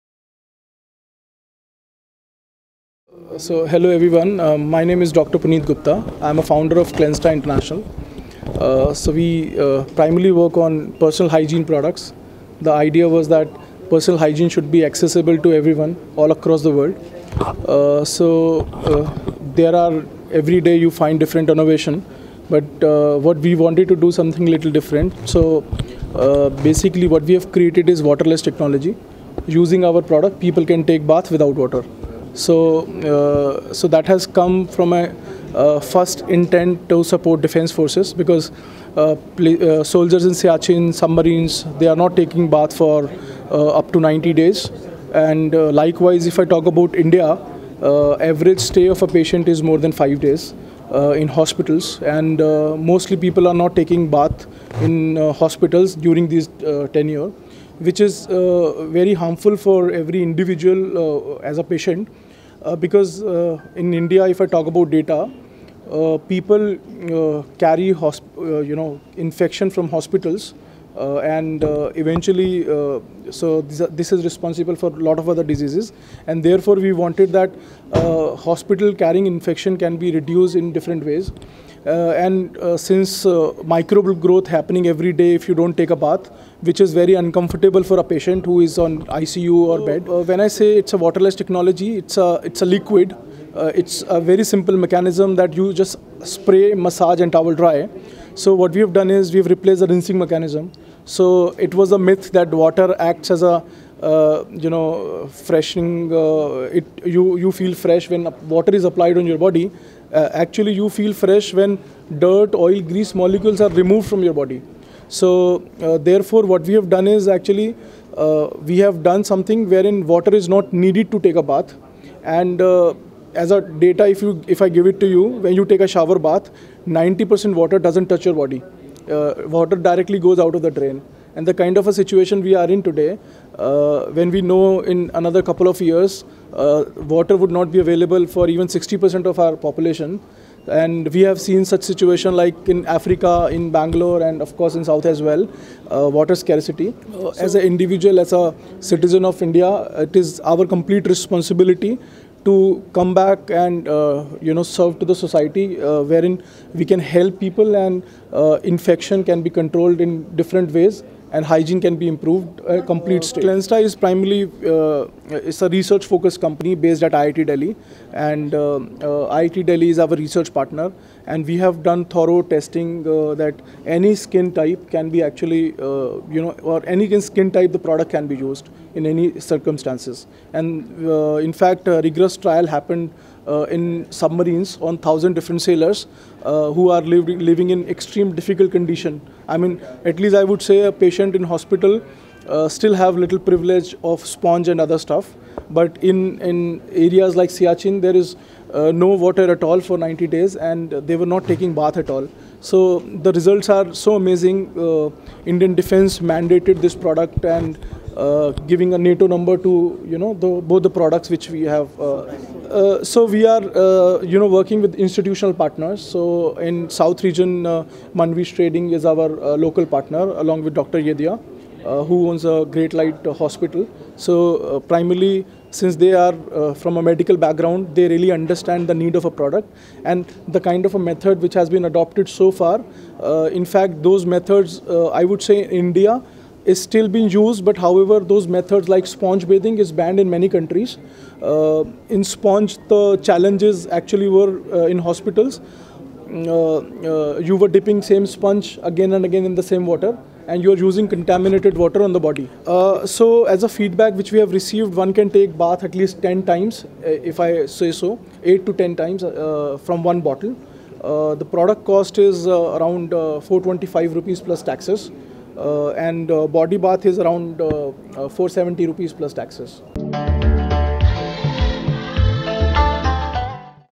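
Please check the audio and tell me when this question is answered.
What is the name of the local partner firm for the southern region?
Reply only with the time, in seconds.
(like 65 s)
217 s.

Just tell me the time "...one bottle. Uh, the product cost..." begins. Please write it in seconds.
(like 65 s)
260 s.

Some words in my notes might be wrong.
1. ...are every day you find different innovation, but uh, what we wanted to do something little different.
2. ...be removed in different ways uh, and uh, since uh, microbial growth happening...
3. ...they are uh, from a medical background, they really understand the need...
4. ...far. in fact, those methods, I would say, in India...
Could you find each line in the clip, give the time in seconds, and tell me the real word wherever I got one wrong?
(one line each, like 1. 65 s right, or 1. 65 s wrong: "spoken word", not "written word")
1. 19 s right
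2. 79 s wrong: "reduced", not "removed"
3. 225 s right
4. 232 s right.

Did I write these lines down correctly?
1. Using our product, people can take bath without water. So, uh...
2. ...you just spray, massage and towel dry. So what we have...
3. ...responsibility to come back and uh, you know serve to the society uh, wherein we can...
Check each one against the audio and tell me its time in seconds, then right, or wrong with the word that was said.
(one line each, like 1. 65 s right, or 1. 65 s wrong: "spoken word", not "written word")
1. 29 s right
2. 95 s right
3. 151 s right.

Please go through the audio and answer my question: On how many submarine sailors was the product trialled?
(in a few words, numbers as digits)
1000.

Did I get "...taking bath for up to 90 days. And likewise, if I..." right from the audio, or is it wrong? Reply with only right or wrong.
right.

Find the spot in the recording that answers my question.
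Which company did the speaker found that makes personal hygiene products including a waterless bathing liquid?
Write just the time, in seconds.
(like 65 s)
6 s.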